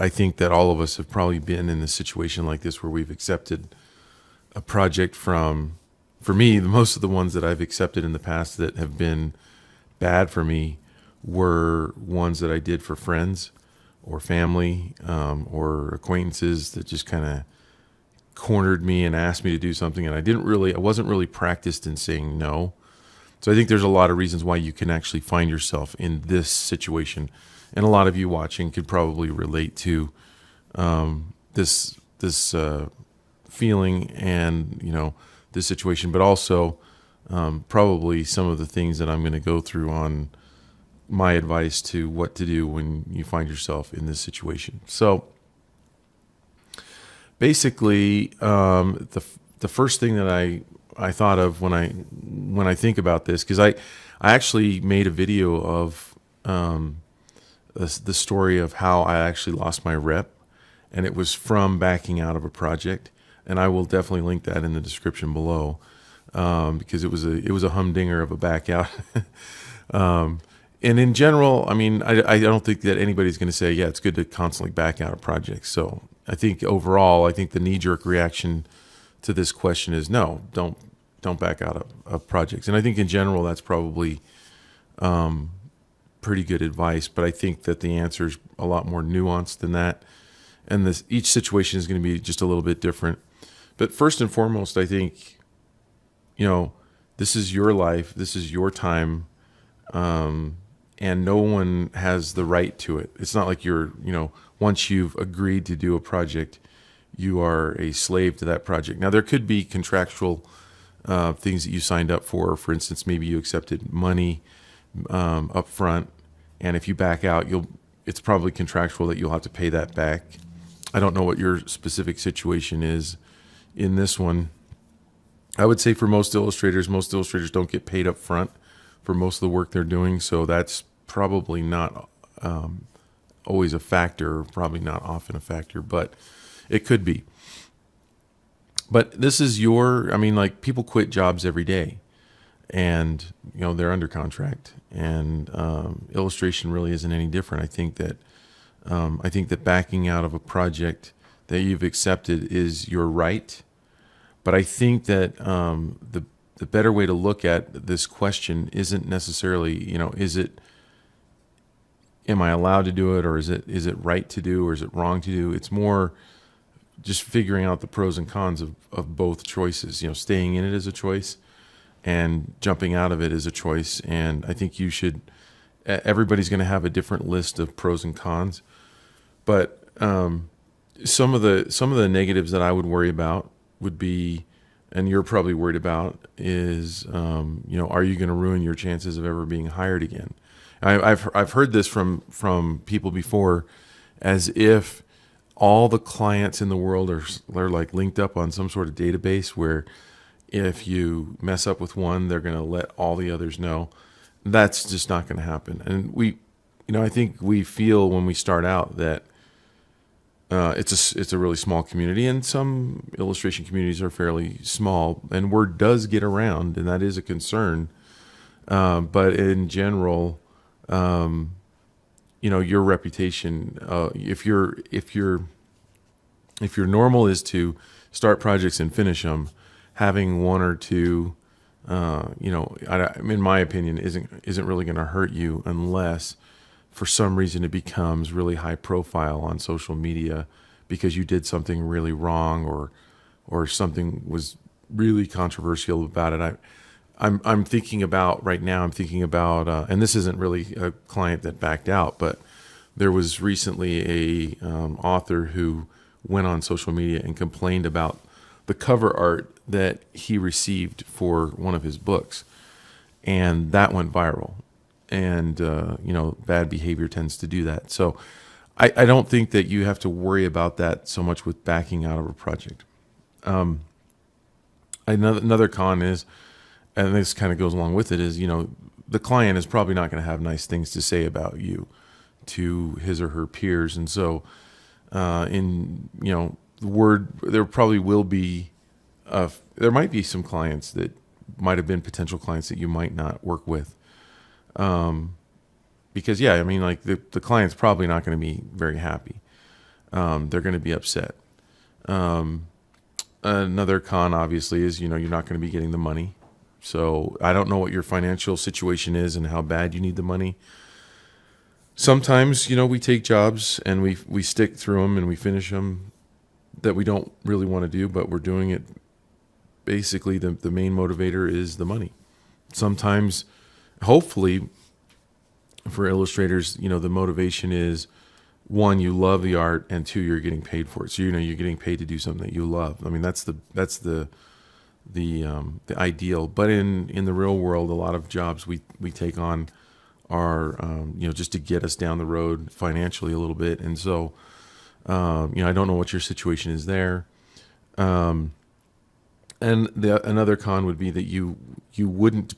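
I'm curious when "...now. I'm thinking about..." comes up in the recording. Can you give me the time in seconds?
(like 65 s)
248 s.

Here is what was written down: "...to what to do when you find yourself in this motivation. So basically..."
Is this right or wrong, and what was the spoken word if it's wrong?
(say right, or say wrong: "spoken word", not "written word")
wrong: "situation", not "motivation".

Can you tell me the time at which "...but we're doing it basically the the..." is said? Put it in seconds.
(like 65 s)
318 s.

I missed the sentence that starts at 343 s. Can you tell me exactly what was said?
And so um, you know I don't know what your situation is there.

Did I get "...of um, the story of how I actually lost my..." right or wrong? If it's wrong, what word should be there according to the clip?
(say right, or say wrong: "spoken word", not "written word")
right.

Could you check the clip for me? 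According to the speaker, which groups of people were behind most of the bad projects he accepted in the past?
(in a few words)
friends or family.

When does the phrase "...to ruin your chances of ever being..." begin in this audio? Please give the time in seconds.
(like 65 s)
188 s.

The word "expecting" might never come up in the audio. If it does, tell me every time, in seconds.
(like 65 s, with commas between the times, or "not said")
not said.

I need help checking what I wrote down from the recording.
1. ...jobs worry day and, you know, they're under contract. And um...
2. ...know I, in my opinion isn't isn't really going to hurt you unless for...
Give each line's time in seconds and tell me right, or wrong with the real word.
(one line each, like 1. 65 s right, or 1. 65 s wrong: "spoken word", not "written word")
1. 141 s wrong: "every", not "worry"
2. 232 s right.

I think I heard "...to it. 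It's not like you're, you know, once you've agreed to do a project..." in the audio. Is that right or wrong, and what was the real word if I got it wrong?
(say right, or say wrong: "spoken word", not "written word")
right.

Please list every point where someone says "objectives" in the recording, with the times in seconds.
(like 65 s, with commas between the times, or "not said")
not said.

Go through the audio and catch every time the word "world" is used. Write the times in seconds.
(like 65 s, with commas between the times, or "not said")
196 s, 337 s.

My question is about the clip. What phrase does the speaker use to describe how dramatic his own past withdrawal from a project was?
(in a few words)
a humdinger.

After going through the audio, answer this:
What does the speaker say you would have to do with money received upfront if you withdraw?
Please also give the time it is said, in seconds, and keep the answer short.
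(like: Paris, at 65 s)
pay that back, at 119 s.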